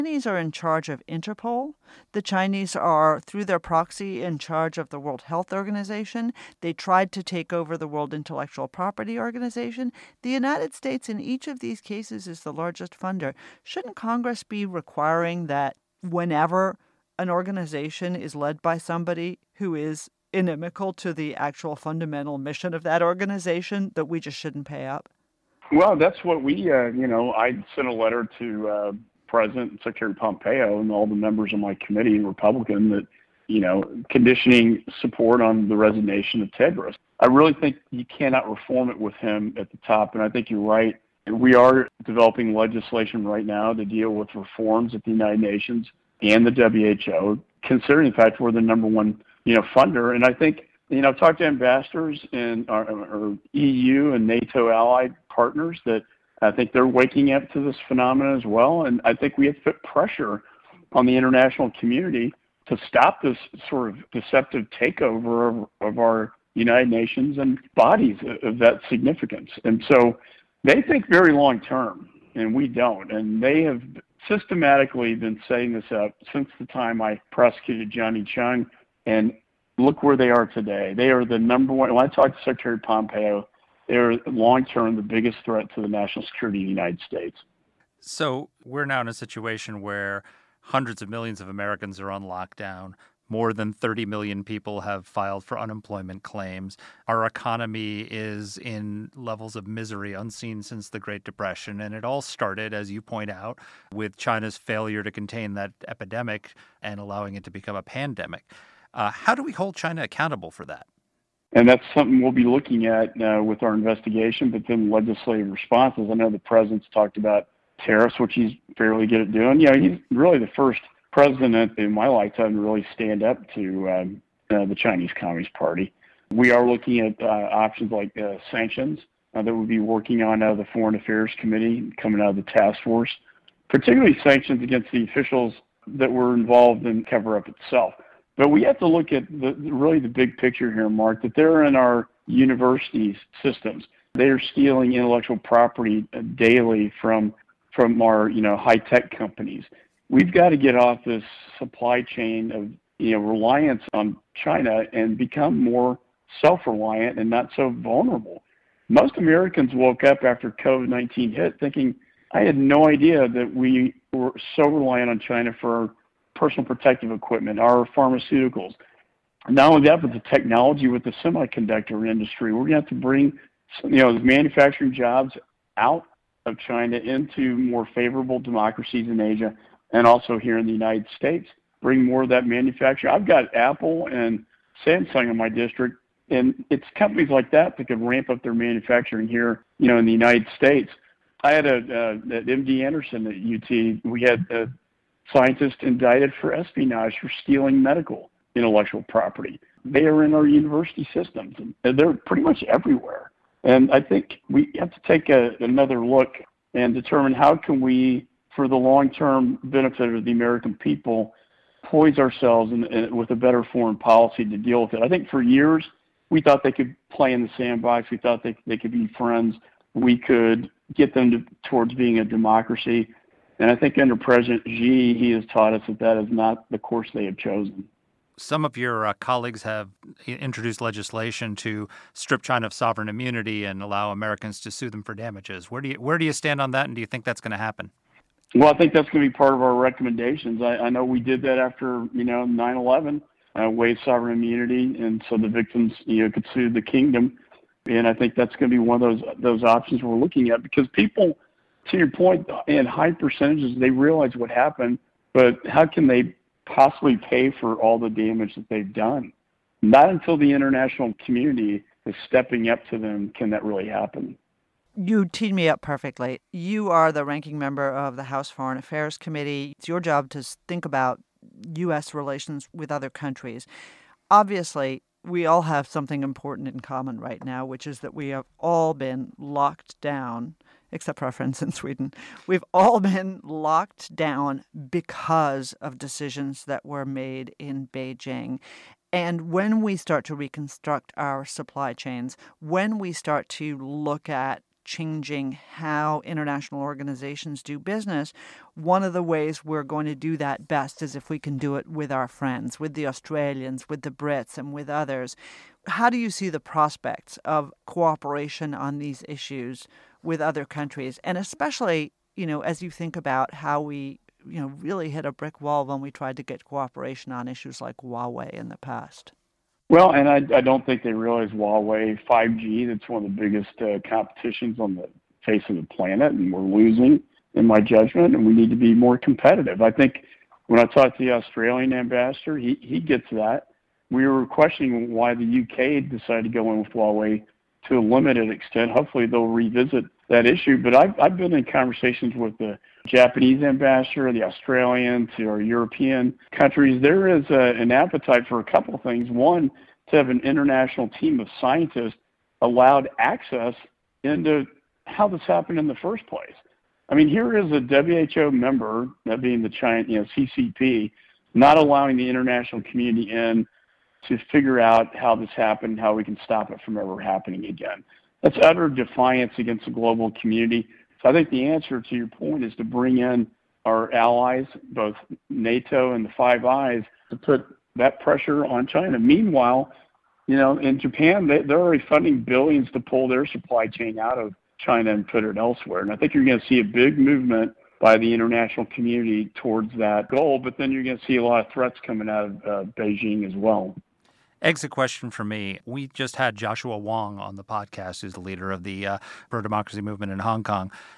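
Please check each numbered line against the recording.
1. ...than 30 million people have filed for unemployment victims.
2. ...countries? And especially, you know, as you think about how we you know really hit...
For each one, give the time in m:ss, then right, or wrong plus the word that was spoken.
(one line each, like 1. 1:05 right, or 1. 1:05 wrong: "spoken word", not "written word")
1. 1:33 wrong: "claims", not "victims"
2. 5:10 right.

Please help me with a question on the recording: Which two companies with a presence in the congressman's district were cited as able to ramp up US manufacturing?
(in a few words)
Apple and Samsung.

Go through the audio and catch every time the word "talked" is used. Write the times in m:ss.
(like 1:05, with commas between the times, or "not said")
0:51, 1:22, 1:56, 5:30.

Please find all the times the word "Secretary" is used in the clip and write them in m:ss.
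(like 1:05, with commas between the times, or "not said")
0:29, 1:22.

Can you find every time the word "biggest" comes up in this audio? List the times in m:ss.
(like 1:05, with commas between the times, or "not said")
1:25, 5:23.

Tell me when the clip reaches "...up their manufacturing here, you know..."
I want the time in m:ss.
3:08.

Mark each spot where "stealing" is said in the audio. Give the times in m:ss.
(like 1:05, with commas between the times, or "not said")
2:24, 3:17.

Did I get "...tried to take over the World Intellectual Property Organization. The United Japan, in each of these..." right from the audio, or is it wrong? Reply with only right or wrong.
wrong.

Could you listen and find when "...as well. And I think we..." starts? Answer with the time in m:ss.
0:58.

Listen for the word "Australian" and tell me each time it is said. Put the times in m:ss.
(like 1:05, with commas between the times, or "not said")
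5:03, 5:31, 5:44.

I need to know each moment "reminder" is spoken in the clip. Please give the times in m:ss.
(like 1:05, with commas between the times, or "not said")
not said.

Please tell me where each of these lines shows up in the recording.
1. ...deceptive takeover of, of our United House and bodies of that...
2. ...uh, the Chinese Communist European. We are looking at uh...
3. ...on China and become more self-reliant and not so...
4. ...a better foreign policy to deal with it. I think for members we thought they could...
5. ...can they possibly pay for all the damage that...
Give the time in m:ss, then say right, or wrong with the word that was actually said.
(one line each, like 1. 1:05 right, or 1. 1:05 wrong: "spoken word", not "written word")
1. 1:04 wrong: "Nations", not "House"
2. 2:04 wrong: "Party", not "European"
3. 2:33 right
4. 3:33 wrong: "years", not "members"
5. 4:15 right.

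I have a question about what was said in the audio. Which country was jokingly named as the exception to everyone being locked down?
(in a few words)
Sweden.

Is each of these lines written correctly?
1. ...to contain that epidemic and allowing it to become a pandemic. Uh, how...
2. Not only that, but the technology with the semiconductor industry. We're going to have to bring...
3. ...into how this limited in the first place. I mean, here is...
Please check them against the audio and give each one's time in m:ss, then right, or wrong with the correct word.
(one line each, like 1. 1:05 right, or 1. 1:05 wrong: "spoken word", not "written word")
1. 1:45 right
2. 2:49 right
3. 5:54 wrong: "happened", not "limited".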